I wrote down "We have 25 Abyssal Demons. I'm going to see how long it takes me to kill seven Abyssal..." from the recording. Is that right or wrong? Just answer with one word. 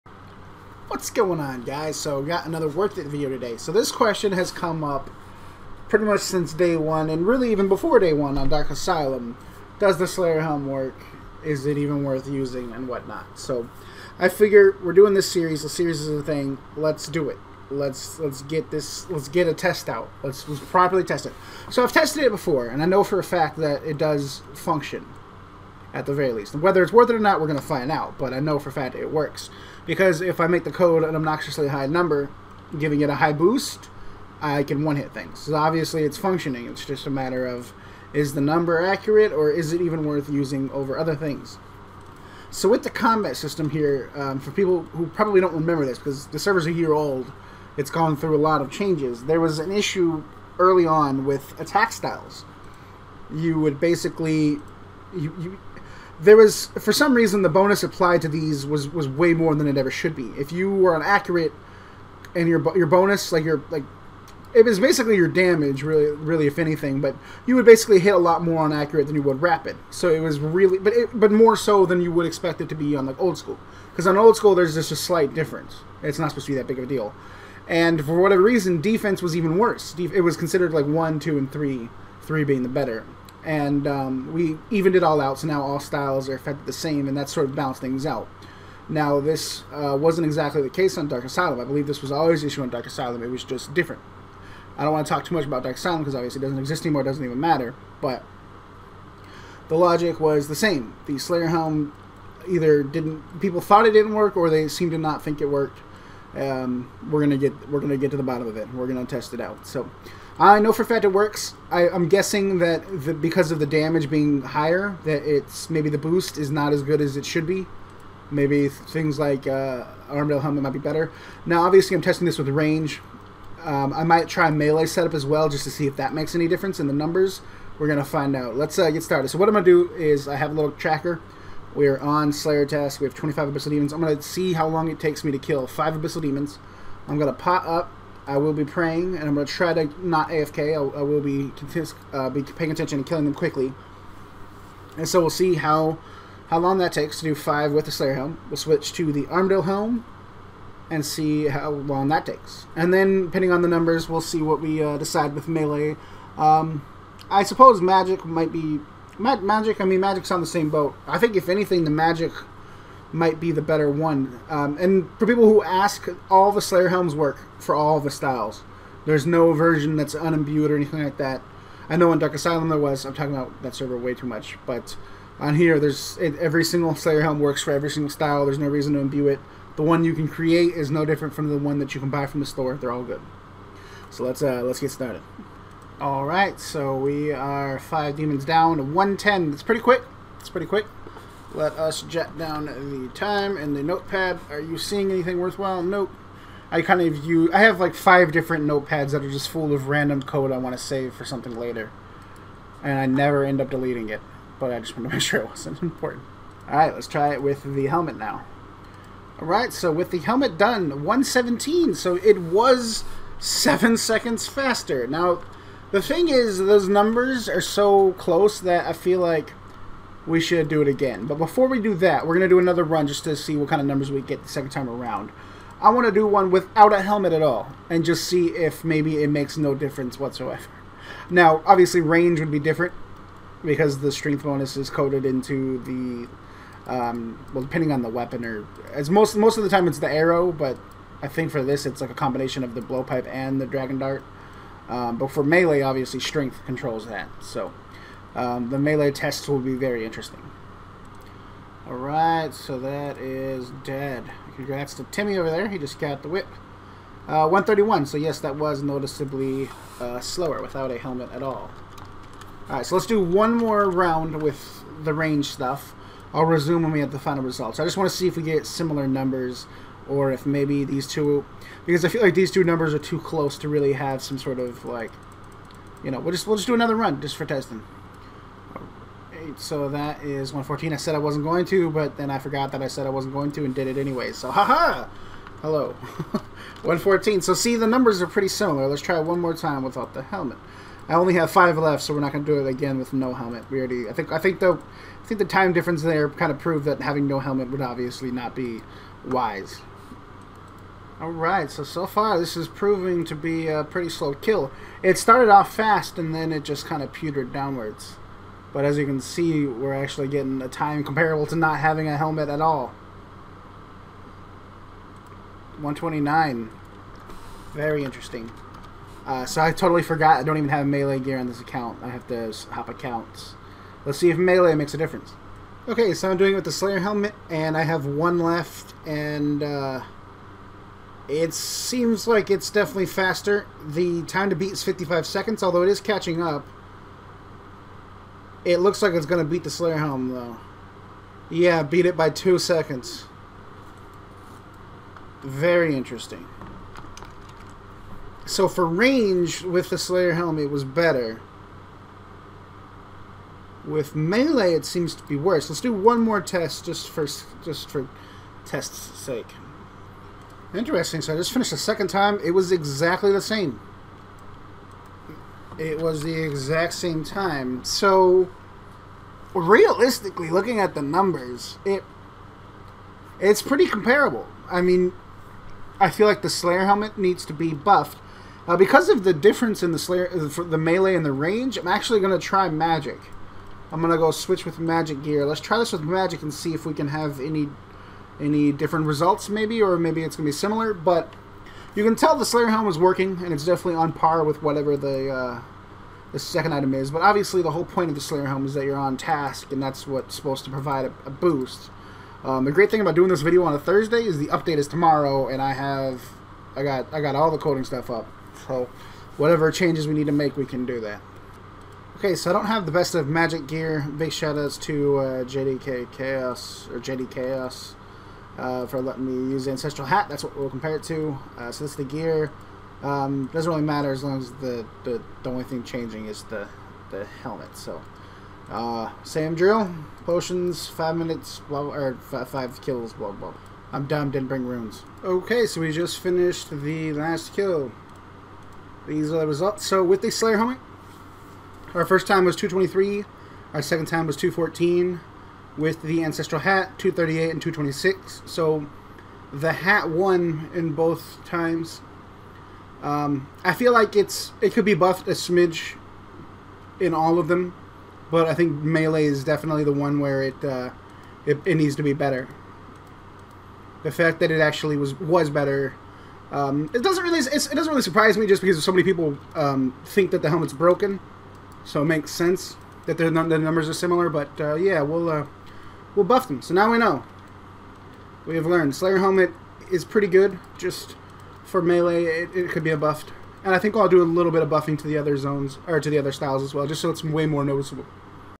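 wrong.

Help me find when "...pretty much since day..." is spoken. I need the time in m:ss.
0:05.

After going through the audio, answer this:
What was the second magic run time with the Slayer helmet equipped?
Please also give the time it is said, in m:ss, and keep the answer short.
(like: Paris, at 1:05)
214, at 7:24.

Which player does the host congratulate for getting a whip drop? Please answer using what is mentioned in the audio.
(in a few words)
Timmy.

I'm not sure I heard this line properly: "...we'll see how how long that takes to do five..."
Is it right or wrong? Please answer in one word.
right.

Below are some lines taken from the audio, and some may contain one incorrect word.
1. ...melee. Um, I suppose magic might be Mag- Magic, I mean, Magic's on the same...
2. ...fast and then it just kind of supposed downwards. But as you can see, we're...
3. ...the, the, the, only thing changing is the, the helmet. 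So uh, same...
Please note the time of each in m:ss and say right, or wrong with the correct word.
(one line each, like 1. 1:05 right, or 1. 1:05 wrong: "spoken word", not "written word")
1. 2:35 right
2. 5:05 wrong: "petered", not "supposed"
3. 7:04 right.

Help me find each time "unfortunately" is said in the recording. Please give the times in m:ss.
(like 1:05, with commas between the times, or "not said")
not said.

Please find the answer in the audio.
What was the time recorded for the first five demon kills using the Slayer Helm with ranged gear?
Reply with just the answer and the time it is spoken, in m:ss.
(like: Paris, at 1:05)
110, at 3:08.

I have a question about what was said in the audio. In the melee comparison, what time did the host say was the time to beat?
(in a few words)
55 seconds.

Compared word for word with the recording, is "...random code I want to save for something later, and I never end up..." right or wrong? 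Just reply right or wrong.
right.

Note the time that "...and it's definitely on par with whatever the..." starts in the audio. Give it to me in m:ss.
6:33.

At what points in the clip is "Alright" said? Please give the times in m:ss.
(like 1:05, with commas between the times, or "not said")
4:11, 4:22, 5:01.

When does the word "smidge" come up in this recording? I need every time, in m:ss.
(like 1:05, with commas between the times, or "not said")
7:35.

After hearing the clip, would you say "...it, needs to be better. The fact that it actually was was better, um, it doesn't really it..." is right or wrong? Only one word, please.
right.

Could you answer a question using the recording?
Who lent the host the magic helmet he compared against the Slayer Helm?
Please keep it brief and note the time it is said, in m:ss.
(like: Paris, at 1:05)
JDK Chaos, at 6:55.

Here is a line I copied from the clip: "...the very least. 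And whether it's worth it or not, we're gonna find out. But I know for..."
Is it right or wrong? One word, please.
right.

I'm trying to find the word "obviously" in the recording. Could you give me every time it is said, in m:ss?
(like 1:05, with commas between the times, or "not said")
0:35, 1:36, 2:01, 3:51, 4:05, 4:57, 6:37.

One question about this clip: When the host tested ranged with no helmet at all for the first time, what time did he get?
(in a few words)
131.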